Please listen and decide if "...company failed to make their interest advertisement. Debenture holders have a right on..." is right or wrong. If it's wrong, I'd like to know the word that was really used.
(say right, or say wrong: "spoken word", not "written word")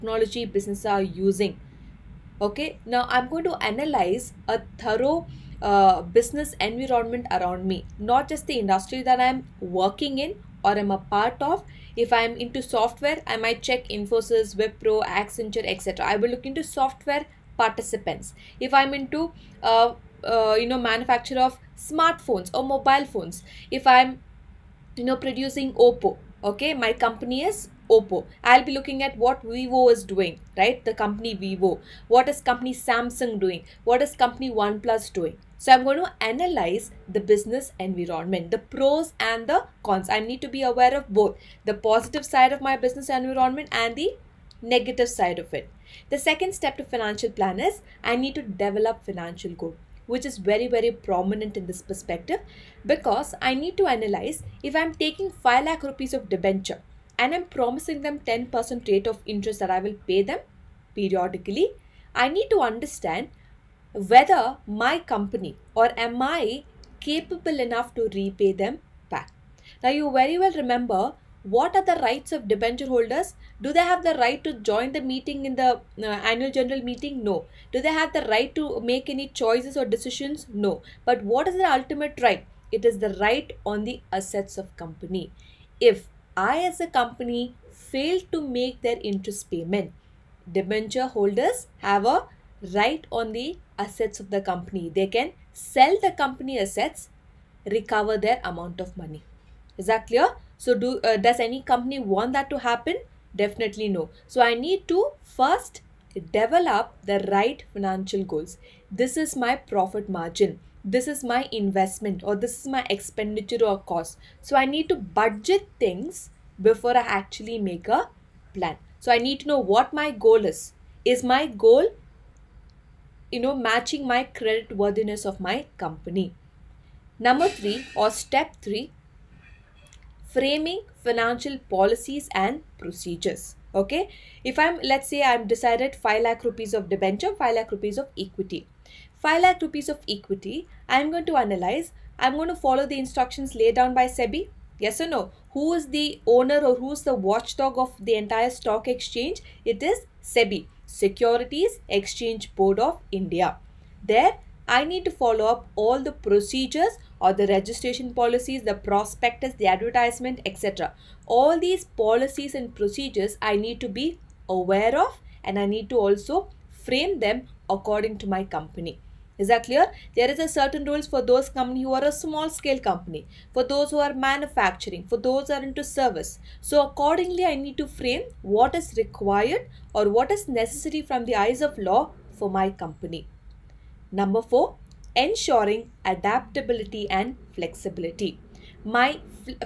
wrong: "payment", not "advertisement".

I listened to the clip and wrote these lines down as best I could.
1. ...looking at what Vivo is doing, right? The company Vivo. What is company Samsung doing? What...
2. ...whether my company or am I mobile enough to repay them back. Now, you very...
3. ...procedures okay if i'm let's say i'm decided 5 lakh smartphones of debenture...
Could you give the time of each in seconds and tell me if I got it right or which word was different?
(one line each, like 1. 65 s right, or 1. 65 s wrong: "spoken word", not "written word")
1. 28 s right
2. 63 s wrong: "capable", not "mobile"
3. 132 s wrong: "rupees", not "smartphones".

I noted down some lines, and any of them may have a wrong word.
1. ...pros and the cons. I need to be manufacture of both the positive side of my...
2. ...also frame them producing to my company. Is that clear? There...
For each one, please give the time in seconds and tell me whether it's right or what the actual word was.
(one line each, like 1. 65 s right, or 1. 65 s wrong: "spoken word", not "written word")
1. 38 s wrong: "aware", not "manufacture"
2. 165 s wrong: "according", not "producing".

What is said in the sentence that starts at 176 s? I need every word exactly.
So accordingly, I need to frame what is required or what is necessary from the eyes of law for my company.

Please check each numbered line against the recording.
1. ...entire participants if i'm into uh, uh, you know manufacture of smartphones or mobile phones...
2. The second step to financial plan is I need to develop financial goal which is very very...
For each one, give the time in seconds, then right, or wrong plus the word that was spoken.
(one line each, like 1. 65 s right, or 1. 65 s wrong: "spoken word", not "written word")
1. 16 s wrong: "software", not "entire"
2. 46 s right.